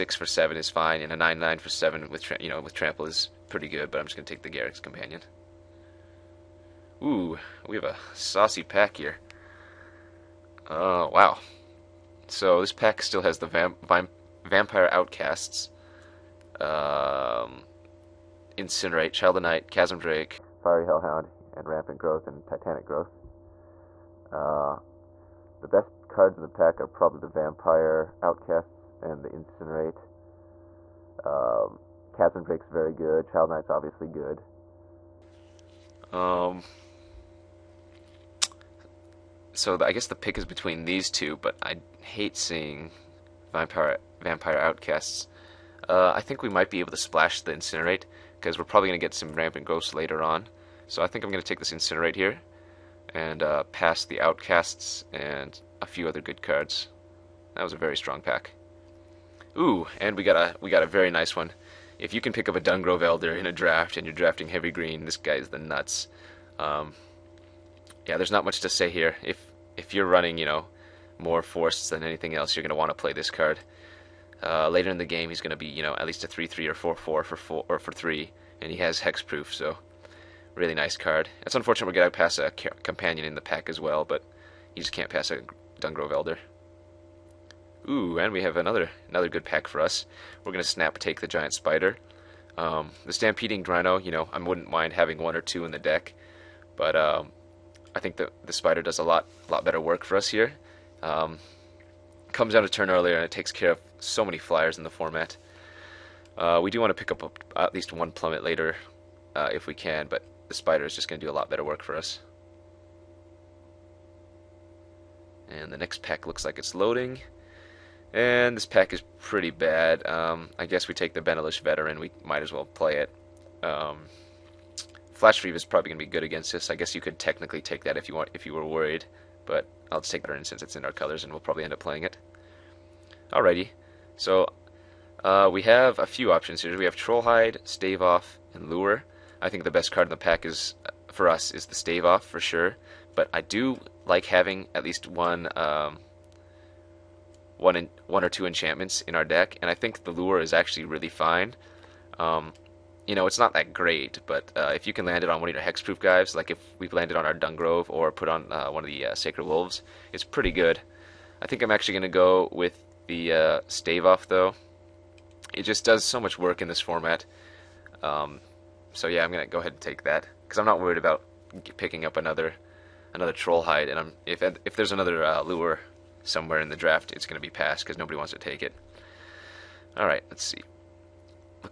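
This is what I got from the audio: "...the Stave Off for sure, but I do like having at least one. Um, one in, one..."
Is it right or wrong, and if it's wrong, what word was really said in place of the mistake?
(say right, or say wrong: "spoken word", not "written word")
right.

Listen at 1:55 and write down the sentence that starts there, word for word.
And the next pack looks like it's loading.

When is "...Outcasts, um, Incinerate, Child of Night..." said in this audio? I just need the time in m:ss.
0:14.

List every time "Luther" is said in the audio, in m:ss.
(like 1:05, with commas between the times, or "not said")
not said.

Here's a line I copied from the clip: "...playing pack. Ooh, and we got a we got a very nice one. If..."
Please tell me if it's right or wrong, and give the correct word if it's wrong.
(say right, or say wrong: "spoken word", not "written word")
wrong: "strong", not "playing".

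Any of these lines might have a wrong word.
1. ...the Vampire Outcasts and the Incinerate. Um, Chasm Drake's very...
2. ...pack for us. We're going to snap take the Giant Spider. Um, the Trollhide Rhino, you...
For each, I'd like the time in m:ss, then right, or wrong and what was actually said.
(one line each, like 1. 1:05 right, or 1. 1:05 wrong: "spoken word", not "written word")
1. 0:27 right
2. 1:29 wrong: "Stampeding", not "Trollhide".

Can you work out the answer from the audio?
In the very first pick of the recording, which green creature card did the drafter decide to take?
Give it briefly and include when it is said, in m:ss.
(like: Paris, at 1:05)
Garruk's Companion, at 0:04.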